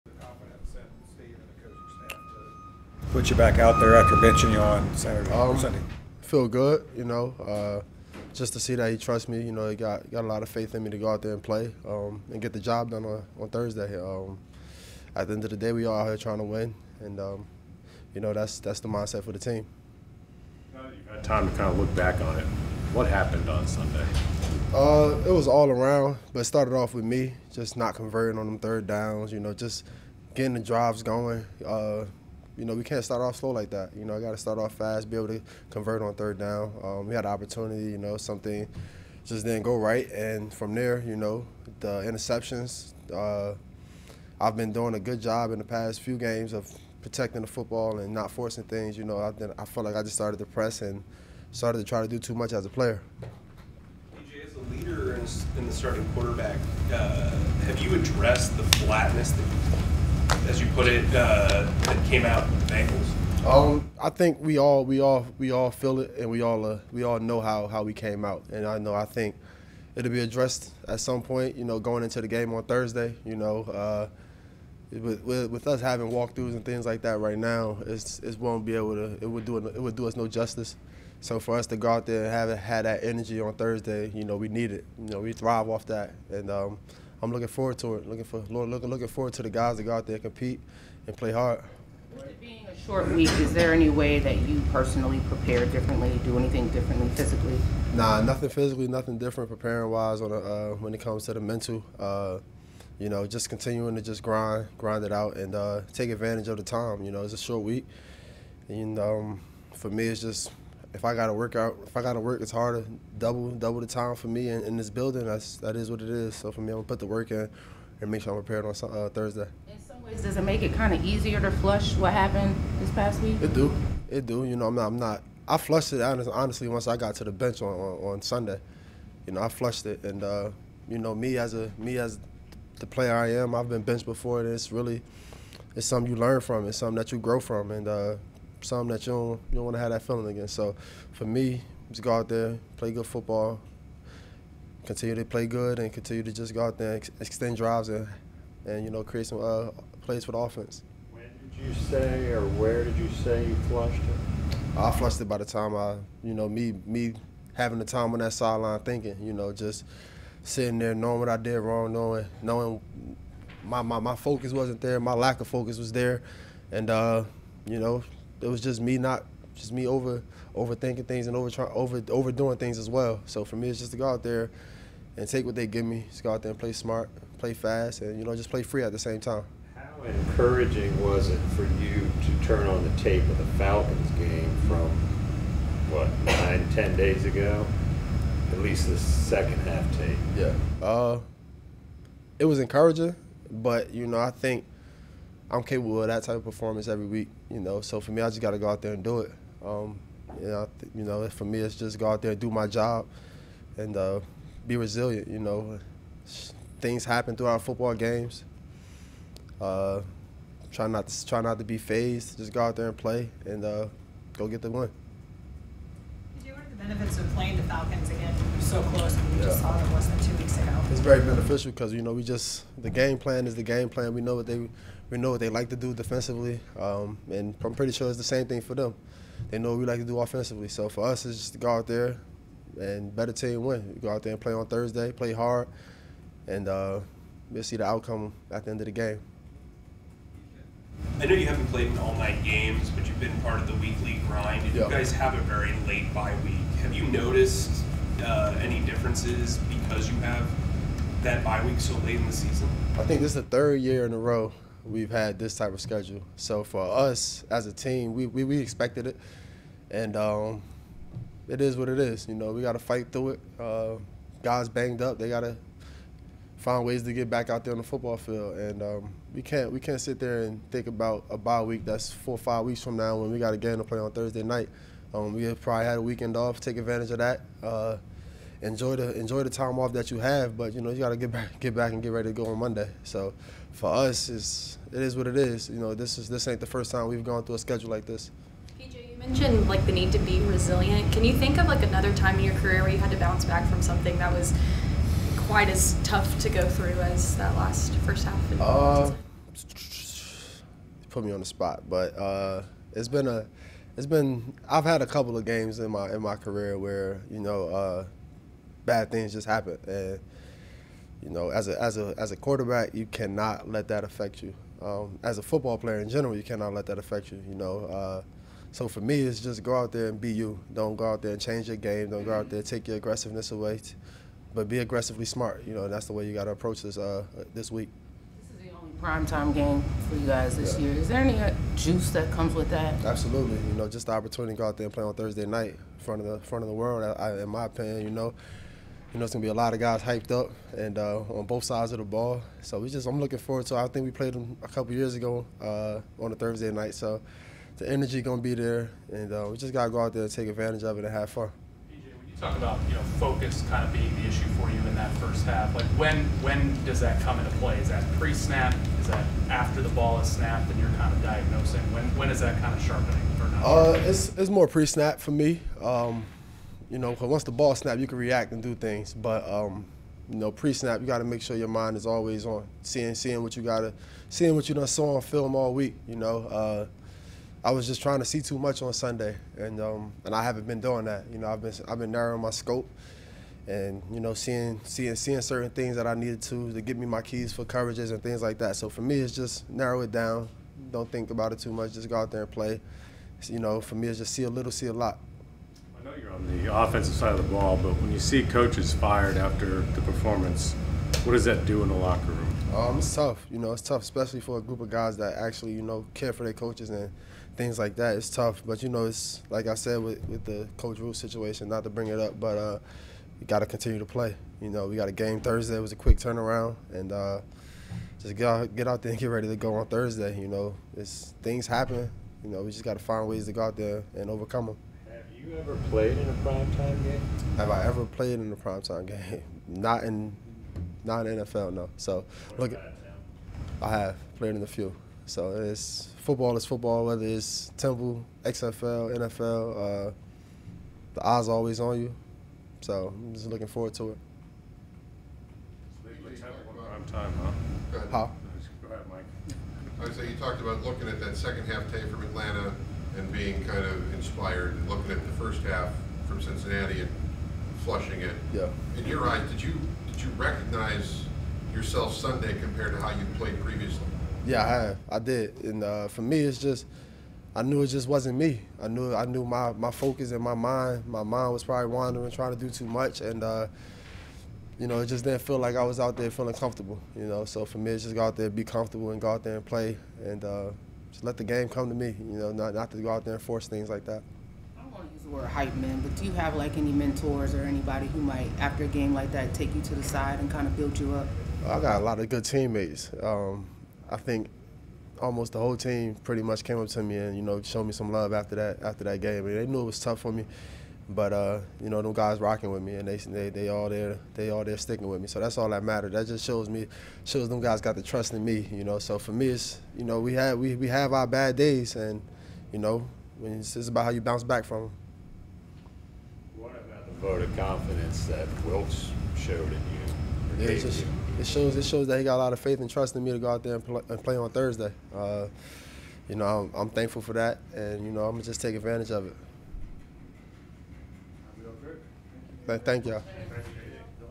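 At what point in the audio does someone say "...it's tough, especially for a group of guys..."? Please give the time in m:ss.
6:43.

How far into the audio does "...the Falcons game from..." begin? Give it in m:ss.
3:03.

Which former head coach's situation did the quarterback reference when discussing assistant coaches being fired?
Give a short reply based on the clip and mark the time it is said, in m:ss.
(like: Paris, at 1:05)
Rhule, at 6:50.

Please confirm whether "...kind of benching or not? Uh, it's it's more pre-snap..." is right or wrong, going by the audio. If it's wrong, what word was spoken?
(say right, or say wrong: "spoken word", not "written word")
wrong: "sharpening", not "benching".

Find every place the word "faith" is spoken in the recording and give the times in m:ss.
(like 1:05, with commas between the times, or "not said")
0:10, 8:42.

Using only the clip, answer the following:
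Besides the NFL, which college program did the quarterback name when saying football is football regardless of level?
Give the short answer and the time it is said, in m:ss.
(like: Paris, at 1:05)
Temple, at 7:17.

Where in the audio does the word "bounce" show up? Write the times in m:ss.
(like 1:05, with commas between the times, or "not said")
4:53, 8:34.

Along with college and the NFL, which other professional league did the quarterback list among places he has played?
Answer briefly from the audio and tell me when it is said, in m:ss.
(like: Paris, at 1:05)
XFL, at 7:18.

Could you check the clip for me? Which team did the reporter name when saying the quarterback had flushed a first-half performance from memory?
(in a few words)
Cincinnati.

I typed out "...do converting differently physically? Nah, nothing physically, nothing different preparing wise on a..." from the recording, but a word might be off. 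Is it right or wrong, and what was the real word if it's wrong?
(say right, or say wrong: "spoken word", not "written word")
wrong: "anything", not "converting".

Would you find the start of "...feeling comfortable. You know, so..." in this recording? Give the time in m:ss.
7:56.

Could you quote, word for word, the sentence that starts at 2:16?
It's something that you grow from, and uh, something that you don't you don't want to have that feeling again.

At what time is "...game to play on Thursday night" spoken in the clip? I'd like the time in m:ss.
4:33.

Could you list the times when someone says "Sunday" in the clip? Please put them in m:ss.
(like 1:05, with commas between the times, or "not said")
0:05, 0:23, 2:08, 6:18, 7:42.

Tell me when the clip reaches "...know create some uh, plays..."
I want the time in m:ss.
2:28.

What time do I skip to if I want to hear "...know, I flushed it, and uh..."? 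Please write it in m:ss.
2:09.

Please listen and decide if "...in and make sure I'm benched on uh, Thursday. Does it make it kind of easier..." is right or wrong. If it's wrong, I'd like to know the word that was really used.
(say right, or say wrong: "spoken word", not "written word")
wrong: "prepared", not "benched".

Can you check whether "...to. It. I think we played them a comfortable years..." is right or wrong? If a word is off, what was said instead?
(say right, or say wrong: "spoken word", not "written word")
wrong: "couple", not "comfortable".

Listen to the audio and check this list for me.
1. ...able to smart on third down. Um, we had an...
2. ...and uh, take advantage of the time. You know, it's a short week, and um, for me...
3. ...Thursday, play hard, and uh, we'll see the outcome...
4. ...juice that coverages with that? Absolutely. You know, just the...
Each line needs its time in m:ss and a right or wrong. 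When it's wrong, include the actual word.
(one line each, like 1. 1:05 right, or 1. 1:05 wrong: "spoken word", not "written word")
1. 0:35 wrong: "convert", not "smart"
2. 1:45 right
3. 3:54 right
4. 5:31 wrong: "comes", not "coverages".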